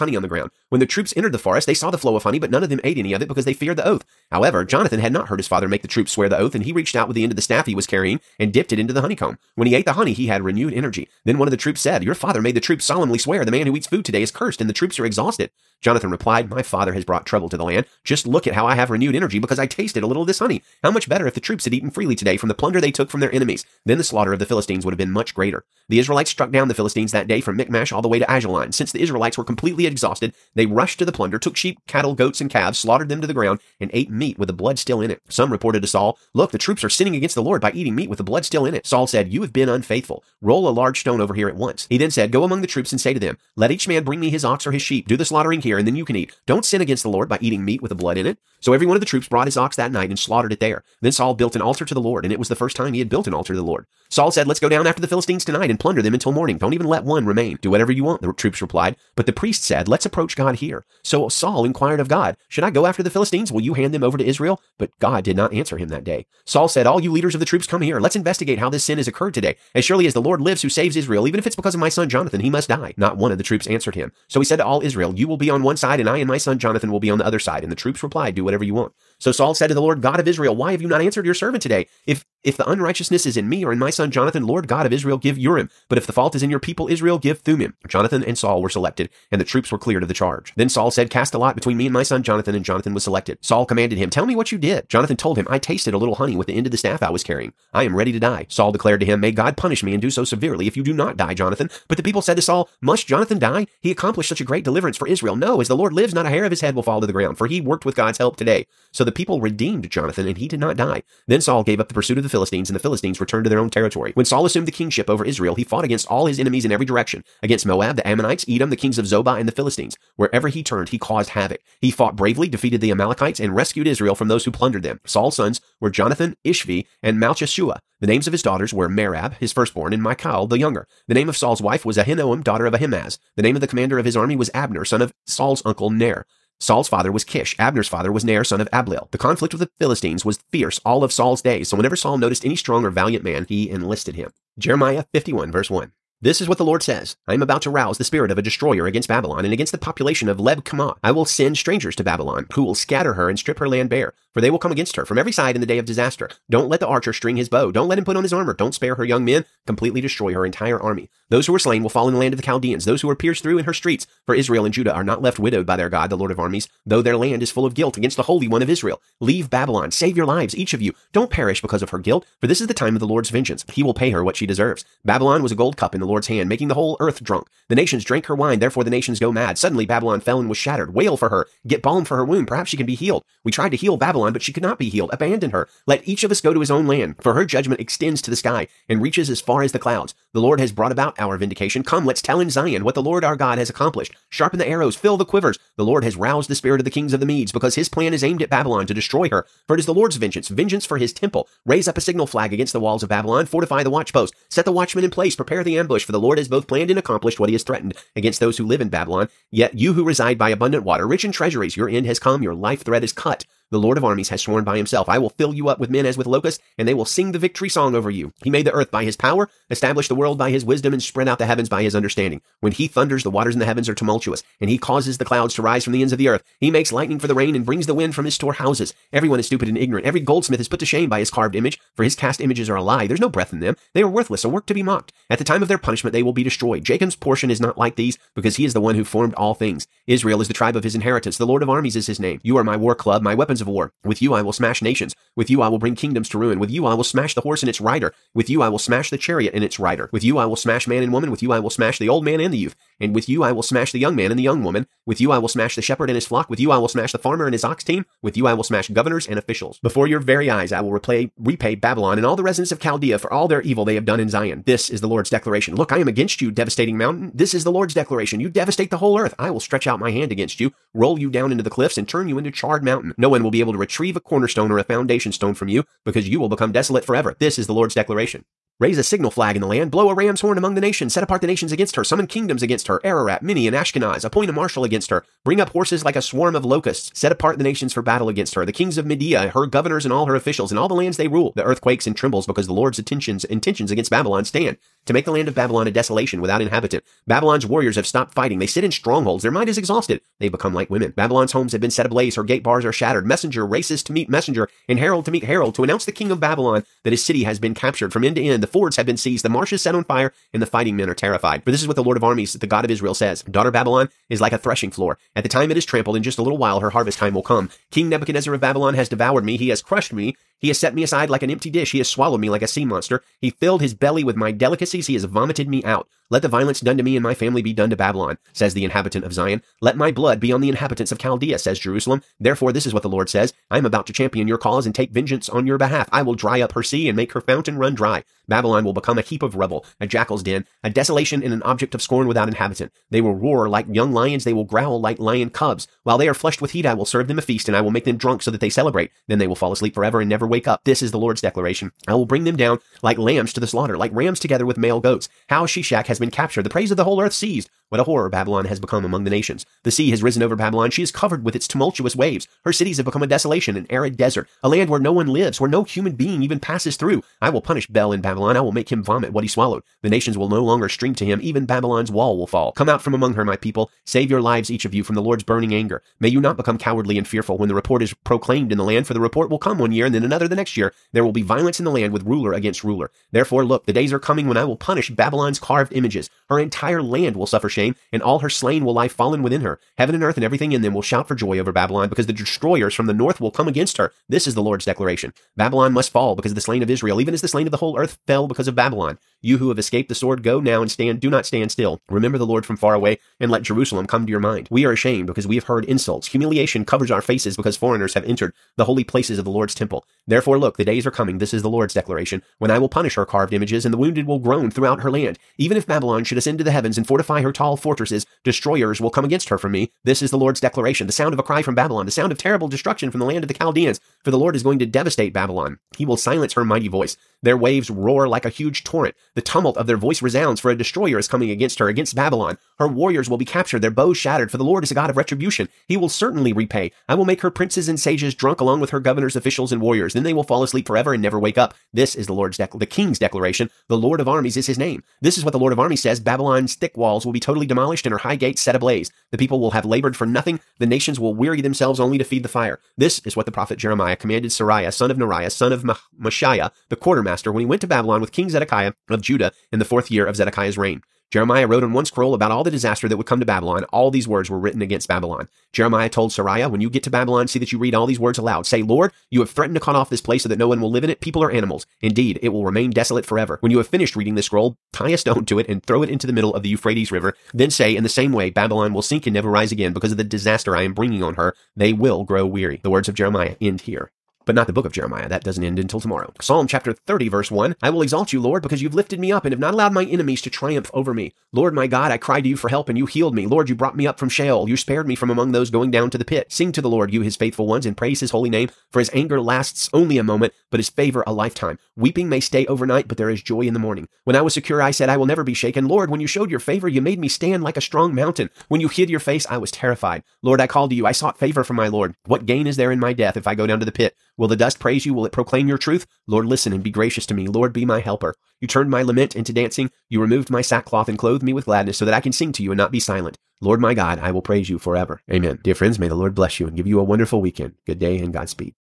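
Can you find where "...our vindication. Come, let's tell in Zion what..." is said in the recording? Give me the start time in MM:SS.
03:11.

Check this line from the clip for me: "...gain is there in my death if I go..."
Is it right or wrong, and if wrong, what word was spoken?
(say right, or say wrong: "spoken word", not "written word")
right.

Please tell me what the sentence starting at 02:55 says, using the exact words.
Babylon was a gold cup in the Lord's hand, making the whole earth drunk.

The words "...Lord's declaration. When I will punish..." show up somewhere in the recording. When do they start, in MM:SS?
06:51.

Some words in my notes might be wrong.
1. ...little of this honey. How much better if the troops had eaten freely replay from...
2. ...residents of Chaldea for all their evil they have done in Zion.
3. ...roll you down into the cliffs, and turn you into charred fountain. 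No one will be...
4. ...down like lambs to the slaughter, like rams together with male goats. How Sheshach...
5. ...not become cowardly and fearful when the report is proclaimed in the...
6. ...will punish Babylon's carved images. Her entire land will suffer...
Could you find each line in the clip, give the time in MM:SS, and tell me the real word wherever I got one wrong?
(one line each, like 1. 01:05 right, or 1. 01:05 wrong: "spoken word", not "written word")
1. 00:20 wrong: "today", not "replay"
2. 04:22 right
3. 04:30 wrong: "mountain", not "fountain"
4. 05:52 right
5. 06:16 right
6. 06:24 right.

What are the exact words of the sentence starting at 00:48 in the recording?
So every one of the troops brought his ox that night and slaughtered it there.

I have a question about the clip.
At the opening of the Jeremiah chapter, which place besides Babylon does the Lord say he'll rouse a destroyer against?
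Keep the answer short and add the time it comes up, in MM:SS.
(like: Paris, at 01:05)
Leb-qamai, at 02:30.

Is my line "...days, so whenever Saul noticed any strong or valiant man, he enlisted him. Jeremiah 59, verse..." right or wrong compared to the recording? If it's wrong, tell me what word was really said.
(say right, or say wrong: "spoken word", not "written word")
wrong: "51", not "59".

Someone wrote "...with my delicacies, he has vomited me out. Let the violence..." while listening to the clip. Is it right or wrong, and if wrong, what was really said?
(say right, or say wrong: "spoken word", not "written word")
right.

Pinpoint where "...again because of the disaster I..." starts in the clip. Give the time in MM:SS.
07:59.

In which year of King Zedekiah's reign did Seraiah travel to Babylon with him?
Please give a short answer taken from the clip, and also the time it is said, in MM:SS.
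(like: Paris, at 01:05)
4th, at 07:39.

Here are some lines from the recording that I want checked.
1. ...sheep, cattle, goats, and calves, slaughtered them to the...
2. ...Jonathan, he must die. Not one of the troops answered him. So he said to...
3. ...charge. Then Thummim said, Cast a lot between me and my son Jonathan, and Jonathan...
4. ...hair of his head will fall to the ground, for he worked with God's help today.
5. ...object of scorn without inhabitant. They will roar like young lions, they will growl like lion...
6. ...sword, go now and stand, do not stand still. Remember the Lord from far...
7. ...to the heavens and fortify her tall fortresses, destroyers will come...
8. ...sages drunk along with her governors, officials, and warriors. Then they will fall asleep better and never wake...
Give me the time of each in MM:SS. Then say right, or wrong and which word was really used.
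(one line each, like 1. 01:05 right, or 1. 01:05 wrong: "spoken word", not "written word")
1. 00:31 right
2. 01:12 right
3. 01:30 wrong: "Saul", not "Thummim"
4. 01:46 right
5. 05:41 right
6. 06:40 right
7. 06:56 right
8. 07:17 wrong: "forever", not "better".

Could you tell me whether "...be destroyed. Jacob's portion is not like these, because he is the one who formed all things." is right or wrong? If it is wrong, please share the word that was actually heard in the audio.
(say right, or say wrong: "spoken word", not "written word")
right.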